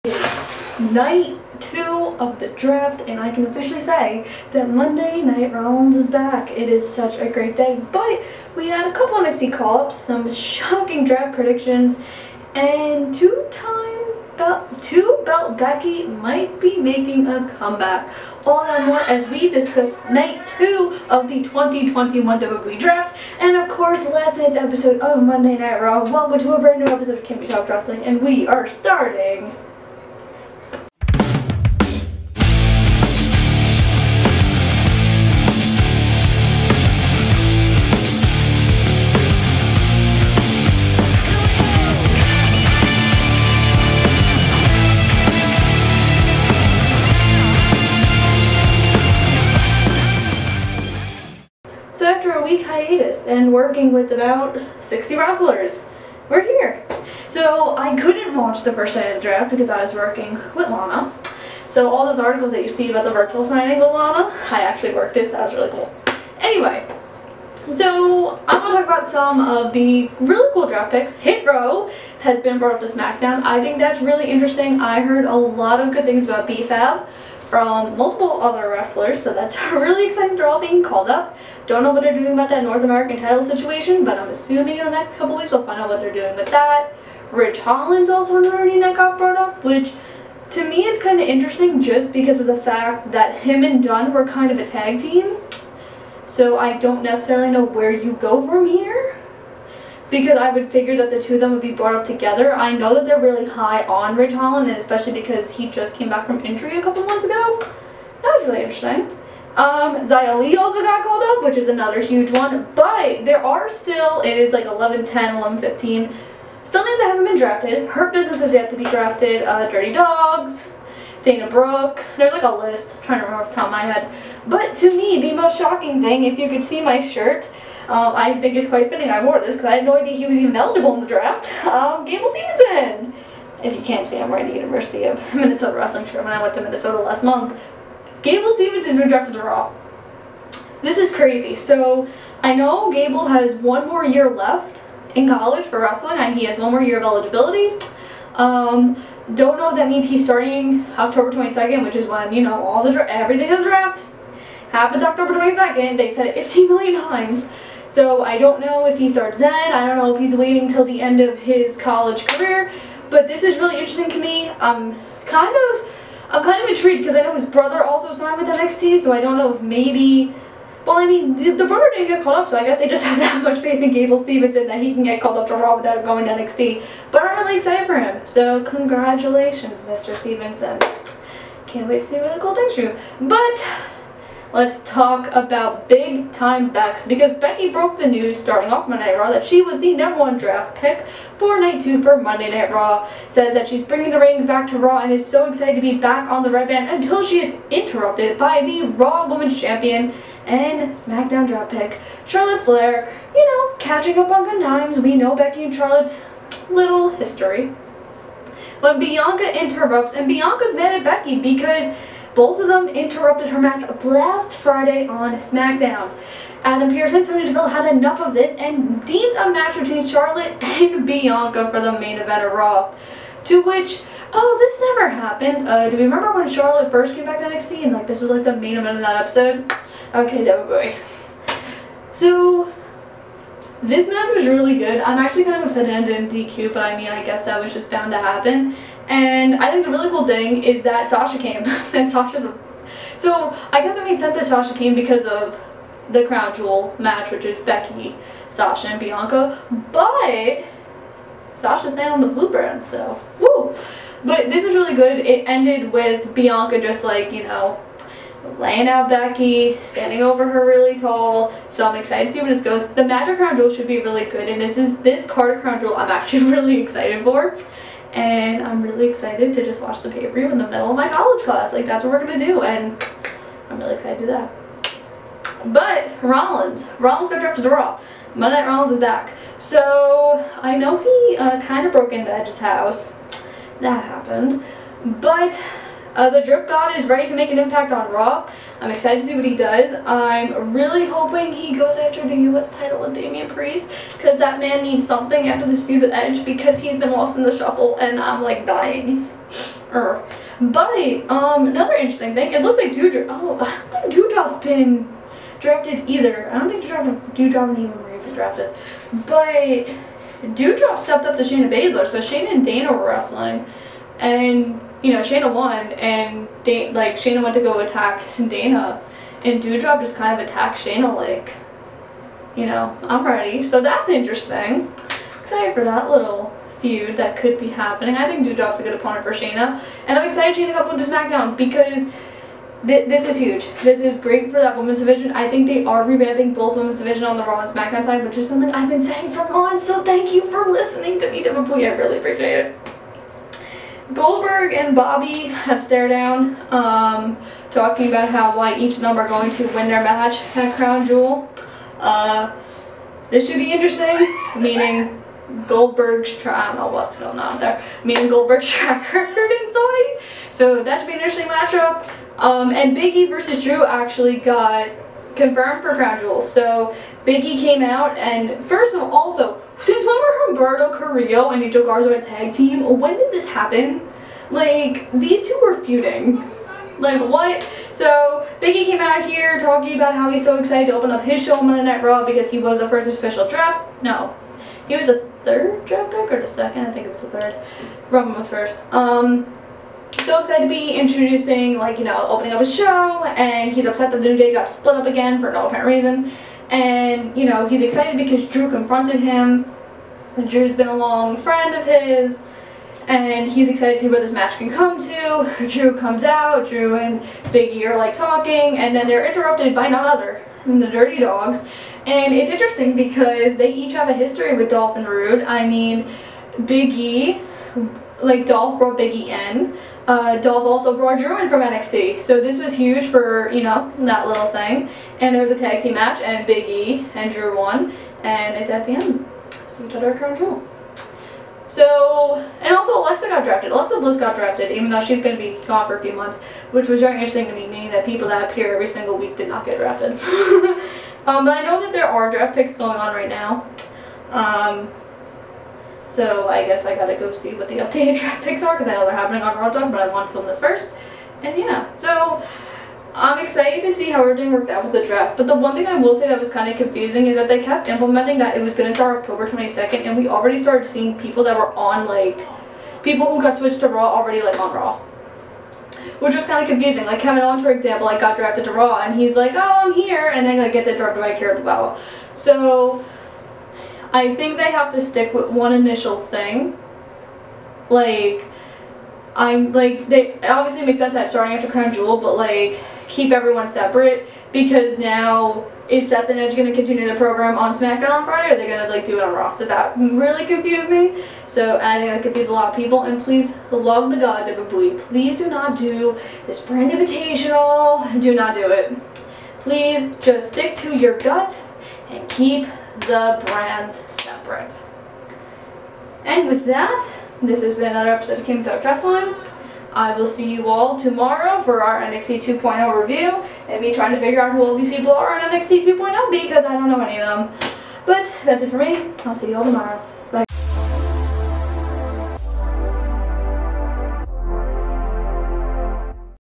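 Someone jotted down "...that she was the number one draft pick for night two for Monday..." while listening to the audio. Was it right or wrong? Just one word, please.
right.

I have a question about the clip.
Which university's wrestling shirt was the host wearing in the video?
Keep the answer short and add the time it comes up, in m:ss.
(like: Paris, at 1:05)
University of Minnesota, at 2:14.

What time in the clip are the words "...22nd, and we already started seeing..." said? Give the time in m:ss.
7:39.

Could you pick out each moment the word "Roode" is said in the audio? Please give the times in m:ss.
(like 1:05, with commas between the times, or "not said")
6:55.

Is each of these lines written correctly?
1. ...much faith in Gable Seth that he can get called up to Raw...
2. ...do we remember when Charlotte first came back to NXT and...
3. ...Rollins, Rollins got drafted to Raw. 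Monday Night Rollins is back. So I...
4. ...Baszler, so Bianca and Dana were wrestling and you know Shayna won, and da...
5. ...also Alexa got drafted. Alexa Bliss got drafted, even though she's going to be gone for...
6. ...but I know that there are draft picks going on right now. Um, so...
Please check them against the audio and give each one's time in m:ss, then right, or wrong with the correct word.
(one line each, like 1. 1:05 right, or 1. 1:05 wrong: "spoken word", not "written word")
1. 2:53 wrong: "Stevenson", not "Seth"
2. 3:45 right
3. 4:36 right
4. 5:11 wrong: "Shayna", not "Bianca"
5. 7:12 right
6. 7:21 right.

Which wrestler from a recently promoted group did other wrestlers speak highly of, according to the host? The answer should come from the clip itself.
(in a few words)
B-Fab.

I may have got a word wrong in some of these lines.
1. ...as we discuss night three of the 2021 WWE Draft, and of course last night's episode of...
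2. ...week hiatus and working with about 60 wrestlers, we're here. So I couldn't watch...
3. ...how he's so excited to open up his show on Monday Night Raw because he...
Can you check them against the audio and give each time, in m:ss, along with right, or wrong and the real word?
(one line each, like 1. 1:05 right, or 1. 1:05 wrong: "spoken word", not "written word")
1. 0:19 wrong: "two", not "three"
2. 0:52 right
3. 6:20 right.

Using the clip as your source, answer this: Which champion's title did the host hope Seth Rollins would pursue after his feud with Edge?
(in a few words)
Damian Priest.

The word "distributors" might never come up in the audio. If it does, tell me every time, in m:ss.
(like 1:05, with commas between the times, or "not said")
not said.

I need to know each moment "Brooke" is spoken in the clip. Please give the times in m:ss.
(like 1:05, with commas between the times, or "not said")
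2:01.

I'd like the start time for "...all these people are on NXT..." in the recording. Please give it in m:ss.
8:34.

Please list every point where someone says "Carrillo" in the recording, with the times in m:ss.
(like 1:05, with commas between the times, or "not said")
6:10.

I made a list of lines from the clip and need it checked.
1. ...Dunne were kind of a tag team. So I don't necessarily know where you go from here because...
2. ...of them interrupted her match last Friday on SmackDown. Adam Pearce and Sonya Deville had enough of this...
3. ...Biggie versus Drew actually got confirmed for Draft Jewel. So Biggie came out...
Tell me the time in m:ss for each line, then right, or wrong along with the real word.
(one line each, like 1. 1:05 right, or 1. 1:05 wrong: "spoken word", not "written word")
1. 1:33 right
2. 3:32 right
3. 6:02 wrong: "Crown", not "Draft".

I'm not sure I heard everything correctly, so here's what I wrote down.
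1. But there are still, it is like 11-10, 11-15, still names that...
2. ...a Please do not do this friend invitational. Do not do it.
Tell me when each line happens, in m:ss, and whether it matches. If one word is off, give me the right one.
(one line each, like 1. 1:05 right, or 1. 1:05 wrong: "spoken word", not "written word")
1. 1:52 right
2. 8:14 wrong: "brand", not "friend".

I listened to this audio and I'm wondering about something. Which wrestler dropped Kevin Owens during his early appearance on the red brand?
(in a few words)
Akira Tozawa.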